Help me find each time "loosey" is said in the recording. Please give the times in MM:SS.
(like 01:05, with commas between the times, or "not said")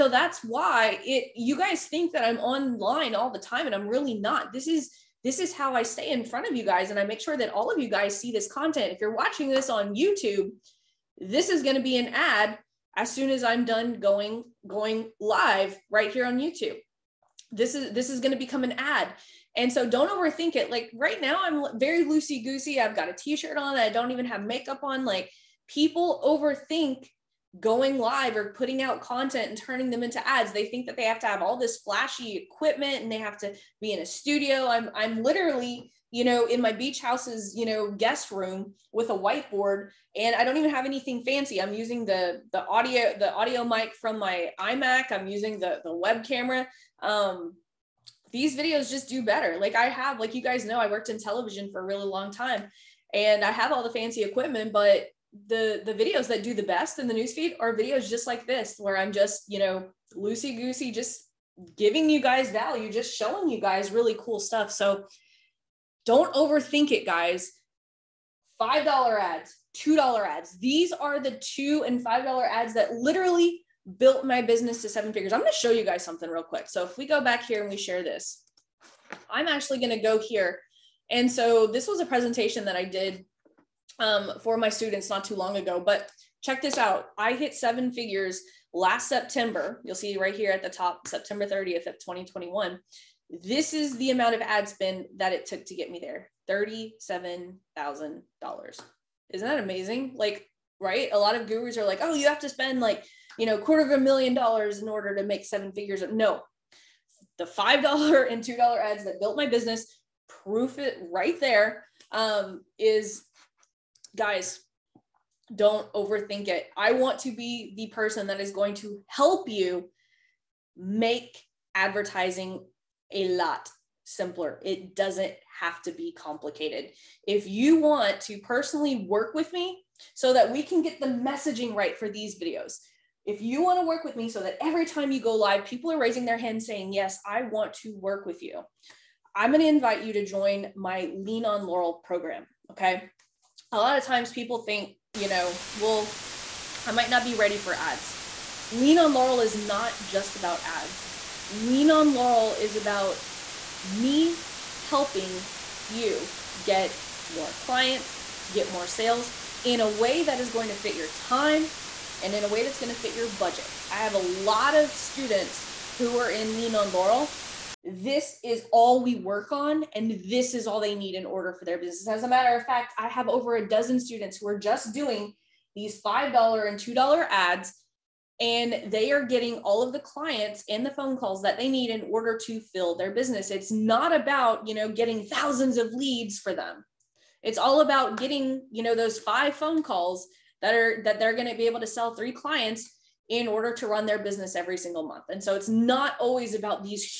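00:22, 01:00.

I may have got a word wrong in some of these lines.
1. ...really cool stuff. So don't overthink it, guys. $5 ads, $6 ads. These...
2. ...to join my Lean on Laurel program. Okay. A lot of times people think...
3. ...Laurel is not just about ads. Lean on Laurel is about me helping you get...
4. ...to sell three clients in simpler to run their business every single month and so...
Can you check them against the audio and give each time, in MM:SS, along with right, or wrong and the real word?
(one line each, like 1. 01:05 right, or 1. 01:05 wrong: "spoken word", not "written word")
1. 01:03 wrong: "2", not "6"
2. 02:20 right
3. 02:29 right
4. 03:11 wrong: "order", not "simpler".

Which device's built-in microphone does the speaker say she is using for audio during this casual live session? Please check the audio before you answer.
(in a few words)
iMac.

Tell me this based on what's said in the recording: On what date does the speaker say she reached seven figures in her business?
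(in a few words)
September 30th, 2021.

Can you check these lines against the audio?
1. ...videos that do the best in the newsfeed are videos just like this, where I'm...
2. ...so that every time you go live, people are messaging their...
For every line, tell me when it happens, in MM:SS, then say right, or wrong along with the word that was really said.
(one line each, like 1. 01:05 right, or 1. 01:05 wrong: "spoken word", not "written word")
1. 00:55 right
2. 02:14 wrong: "raising", not "messaging".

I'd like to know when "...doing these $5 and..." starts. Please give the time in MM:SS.
02:54.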